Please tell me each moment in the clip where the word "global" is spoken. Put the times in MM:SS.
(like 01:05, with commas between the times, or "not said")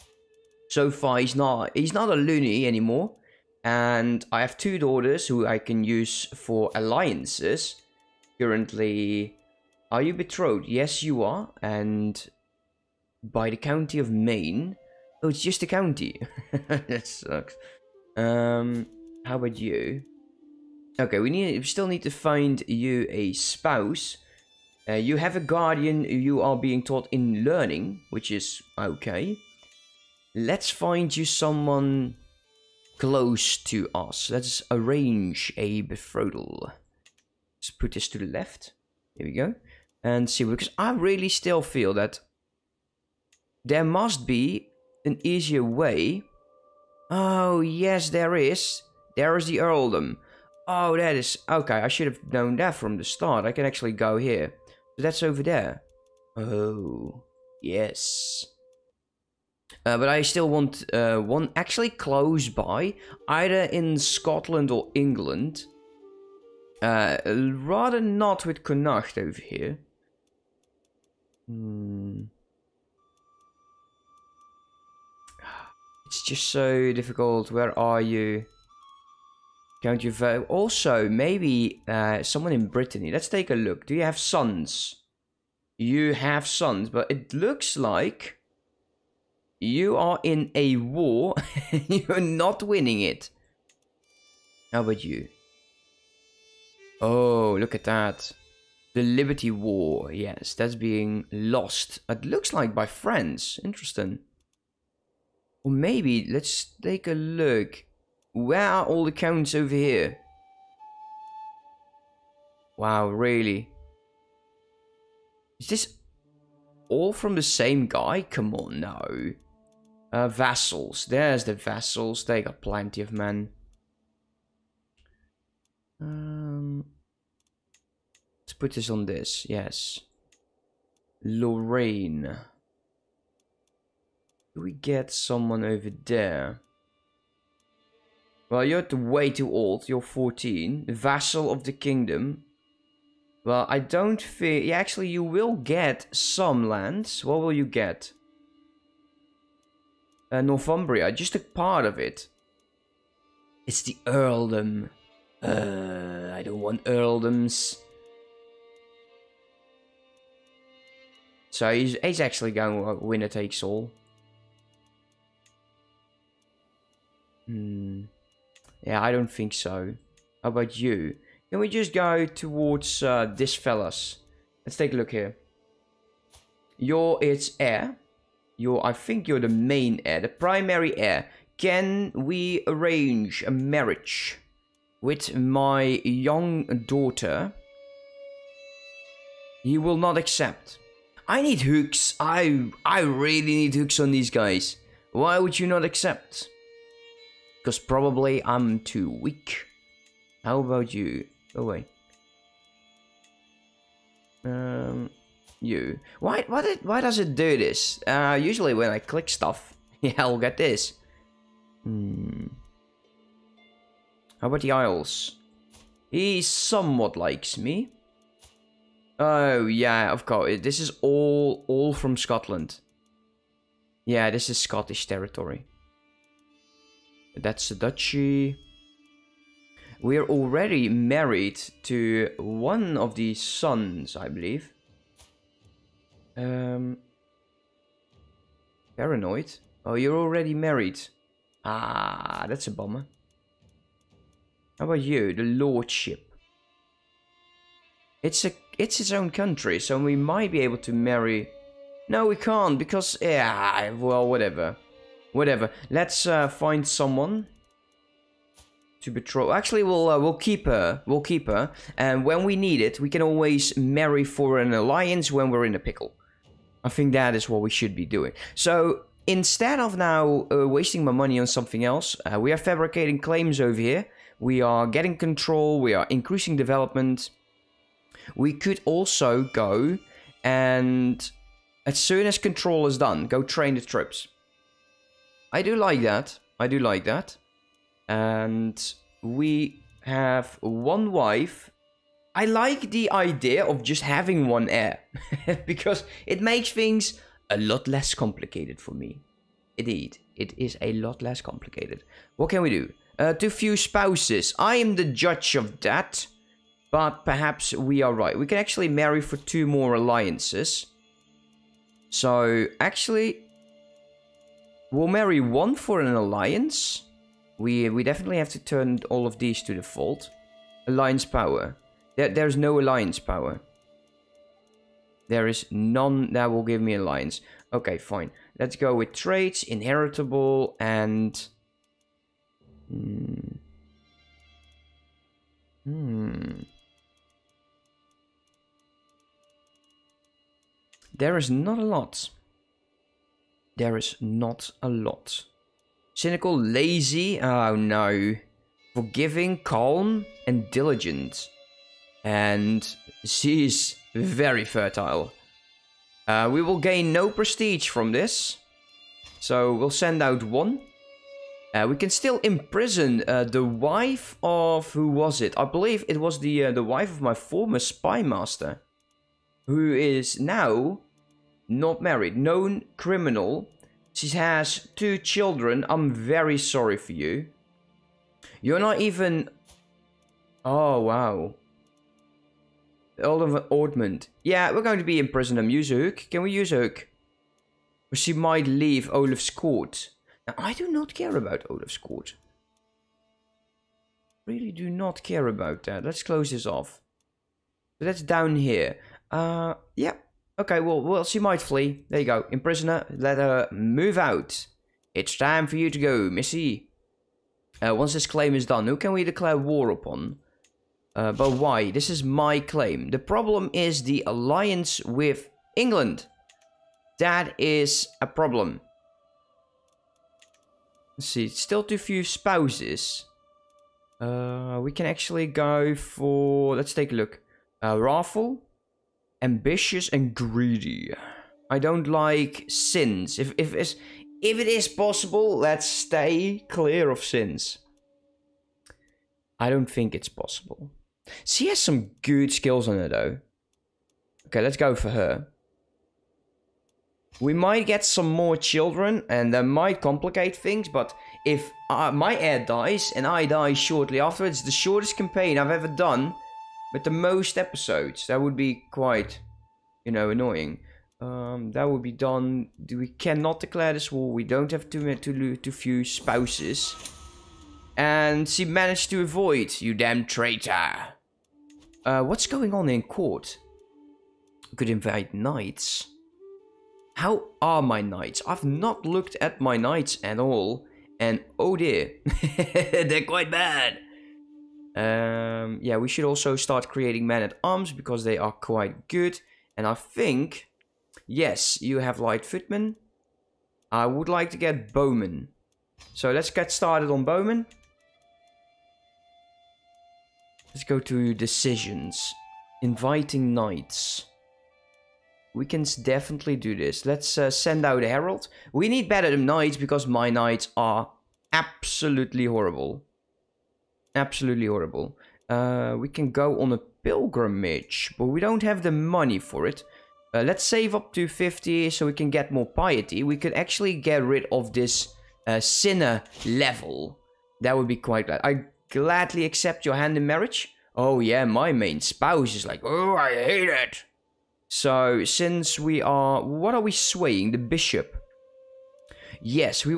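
not said.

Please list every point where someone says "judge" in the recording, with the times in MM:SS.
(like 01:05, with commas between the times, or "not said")
05:05.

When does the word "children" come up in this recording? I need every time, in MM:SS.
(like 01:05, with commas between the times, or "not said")
06:15, 07:28.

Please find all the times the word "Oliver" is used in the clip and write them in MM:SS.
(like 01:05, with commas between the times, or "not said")
06:23.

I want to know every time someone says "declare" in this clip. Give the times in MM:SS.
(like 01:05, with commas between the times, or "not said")
06:49, 07:43.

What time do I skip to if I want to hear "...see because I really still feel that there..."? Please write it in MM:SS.
00:40.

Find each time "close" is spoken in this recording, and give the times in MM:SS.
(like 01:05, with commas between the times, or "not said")
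00:32, 01:01, 06:36.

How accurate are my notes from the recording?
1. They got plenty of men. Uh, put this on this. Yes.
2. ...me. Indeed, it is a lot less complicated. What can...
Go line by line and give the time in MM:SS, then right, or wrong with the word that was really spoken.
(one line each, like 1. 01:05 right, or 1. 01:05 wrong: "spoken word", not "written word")
1. 02:02 right
2. 04:58 right.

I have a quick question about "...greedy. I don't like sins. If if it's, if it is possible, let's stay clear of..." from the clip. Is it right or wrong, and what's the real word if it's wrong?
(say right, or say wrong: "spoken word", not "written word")
right.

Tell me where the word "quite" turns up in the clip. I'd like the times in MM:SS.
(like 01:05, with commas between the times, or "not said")
07:38, 08:03, 08:08, 08:47.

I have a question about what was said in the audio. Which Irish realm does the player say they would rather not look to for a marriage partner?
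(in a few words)
Connacht.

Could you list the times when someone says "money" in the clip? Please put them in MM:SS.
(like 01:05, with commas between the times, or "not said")
04:31, 08:38.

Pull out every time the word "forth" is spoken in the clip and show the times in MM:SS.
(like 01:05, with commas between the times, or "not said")
not said.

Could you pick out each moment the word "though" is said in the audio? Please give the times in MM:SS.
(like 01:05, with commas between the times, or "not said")
07:23.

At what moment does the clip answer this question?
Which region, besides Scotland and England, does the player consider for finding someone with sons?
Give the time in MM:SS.
01:22.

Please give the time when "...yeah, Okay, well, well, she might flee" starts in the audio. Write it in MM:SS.
06:39.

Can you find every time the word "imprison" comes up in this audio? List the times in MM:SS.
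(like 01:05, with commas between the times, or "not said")
06:02, 06:42.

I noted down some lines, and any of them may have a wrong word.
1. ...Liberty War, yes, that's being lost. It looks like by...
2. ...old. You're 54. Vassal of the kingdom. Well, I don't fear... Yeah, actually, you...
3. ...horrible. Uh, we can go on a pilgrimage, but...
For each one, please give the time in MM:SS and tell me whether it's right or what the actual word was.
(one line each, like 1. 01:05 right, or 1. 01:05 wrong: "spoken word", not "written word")
1. 01:39 right
2. 02:19 wrong: "14", not "54"
3. 08:34 right.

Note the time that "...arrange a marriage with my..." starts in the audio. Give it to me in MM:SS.
03:02.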